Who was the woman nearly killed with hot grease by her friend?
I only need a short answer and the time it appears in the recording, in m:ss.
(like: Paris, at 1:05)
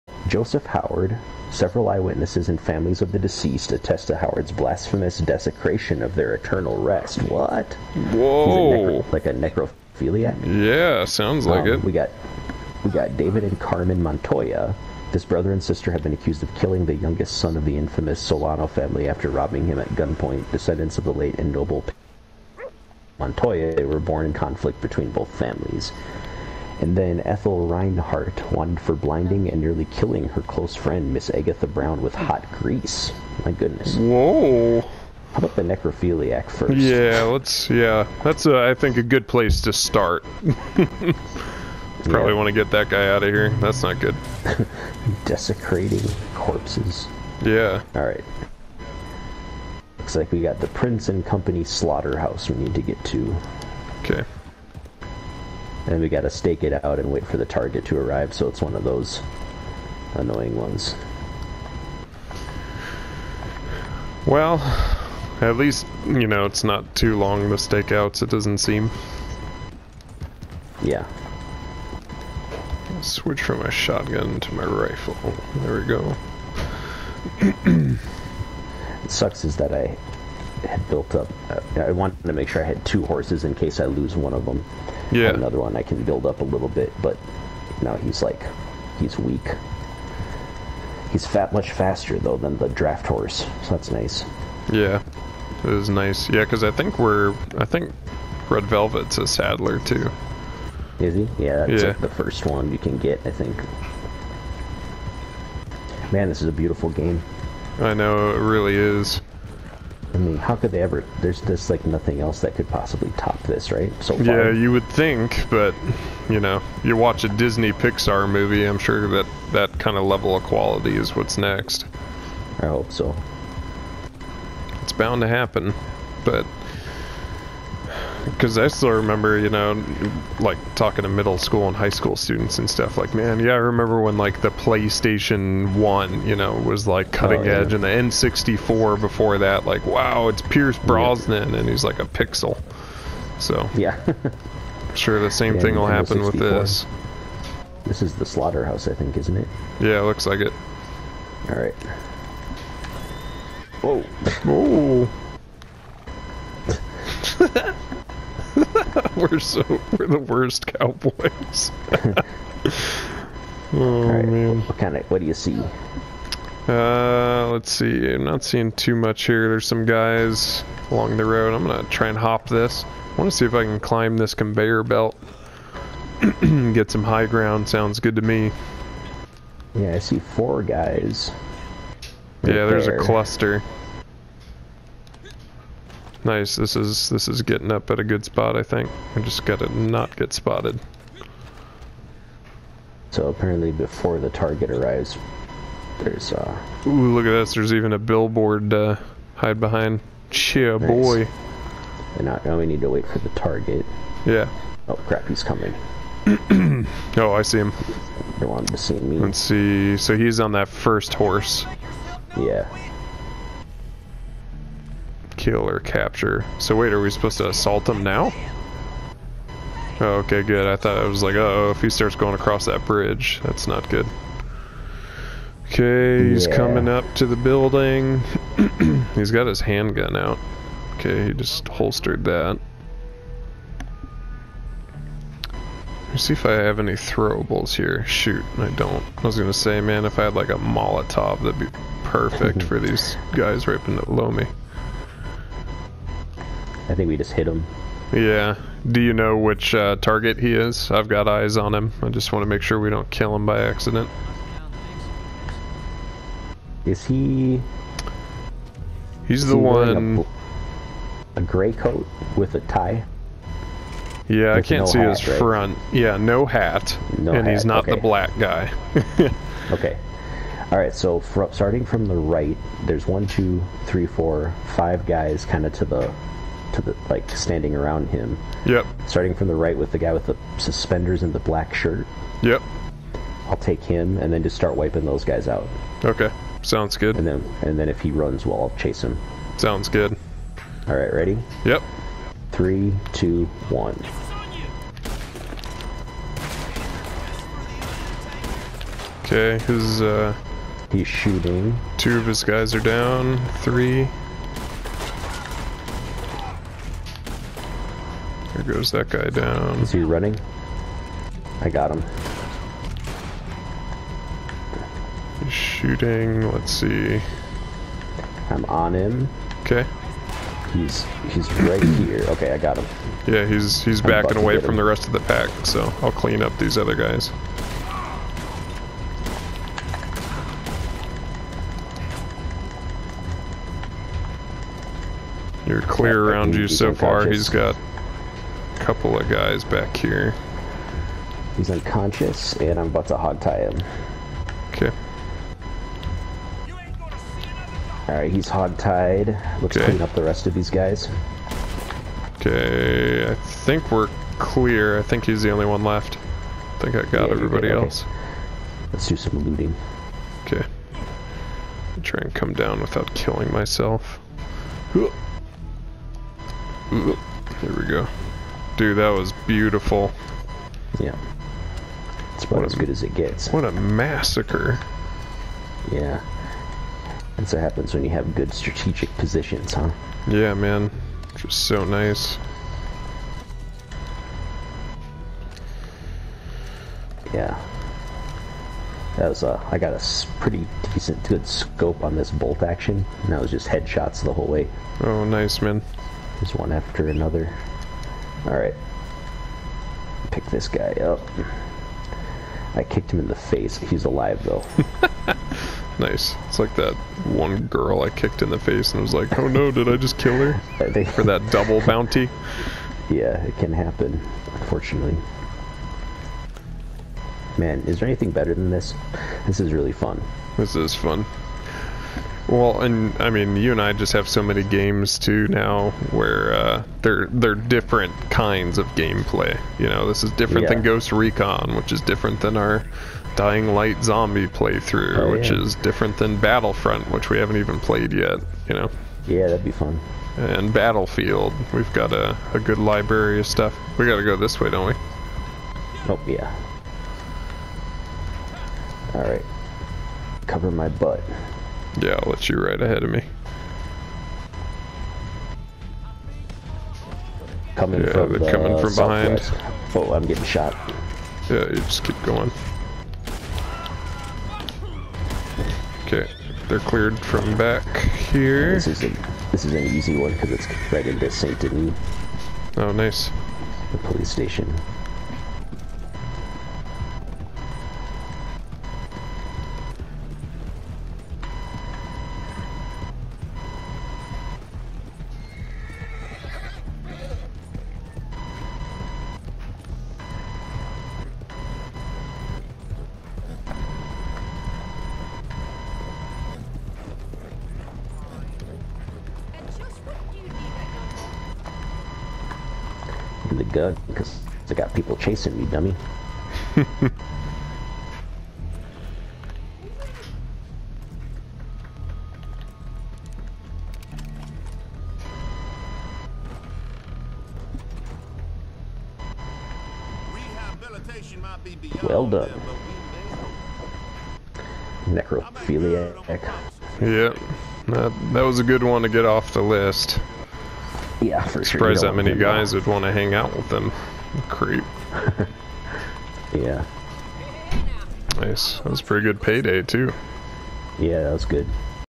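Agatha Brown, at 0:31.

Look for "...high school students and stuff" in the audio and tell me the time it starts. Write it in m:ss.
2:11.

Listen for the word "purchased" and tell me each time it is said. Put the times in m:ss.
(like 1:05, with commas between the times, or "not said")
not said.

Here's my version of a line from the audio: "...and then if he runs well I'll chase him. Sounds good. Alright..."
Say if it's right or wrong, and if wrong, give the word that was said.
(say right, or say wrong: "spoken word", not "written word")
right.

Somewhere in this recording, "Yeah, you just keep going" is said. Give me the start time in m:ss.
7:41.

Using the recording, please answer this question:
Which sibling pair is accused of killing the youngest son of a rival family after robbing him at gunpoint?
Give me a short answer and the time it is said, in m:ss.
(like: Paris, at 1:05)
David and Carmen Montoya, at 0:13.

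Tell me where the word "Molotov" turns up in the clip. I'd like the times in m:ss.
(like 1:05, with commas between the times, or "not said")
4:00.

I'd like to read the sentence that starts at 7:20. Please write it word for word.
And Battlefield, we've got a, a good library of stuff.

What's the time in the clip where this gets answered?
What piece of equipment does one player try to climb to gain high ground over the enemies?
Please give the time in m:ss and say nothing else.
2:54.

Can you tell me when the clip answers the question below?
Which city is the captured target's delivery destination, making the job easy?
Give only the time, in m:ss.
7:51.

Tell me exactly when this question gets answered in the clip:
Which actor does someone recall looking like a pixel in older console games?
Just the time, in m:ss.
2:20.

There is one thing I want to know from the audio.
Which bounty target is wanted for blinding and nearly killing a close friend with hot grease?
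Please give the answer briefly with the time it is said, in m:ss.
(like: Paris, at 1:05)
Ethel Reinhardt, at 0:27.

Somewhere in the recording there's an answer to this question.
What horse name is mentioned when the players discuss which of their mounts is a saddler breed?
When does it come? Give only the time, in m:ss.
1:38.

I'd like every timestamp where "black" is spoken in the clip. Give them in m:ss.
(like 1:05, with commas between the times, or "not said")
4:28, 4:41.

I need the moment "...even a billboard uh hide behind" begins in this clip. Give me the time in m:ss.
3:17.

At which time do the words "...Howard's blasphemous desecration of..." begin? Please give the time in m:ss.
0:04.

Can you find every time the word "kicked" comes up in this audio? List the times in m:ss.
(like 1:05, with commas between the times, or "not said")
6:42, 6:48.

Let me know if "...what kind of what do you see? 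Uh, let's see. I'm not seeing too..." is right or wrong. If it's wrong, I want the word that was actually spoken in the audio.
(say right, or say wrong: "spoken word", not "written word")
right.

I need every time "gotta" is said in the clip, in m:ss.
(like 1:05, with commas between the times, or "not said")
0:56, 3:09, 7:24.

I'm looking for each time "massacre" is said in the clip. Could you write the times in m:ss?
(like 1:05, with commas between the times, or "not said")
6:13.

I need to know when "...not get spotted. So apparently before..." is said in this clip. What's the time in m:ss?
3:09.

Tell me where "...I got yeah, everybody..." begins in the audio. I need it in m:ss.
5:56.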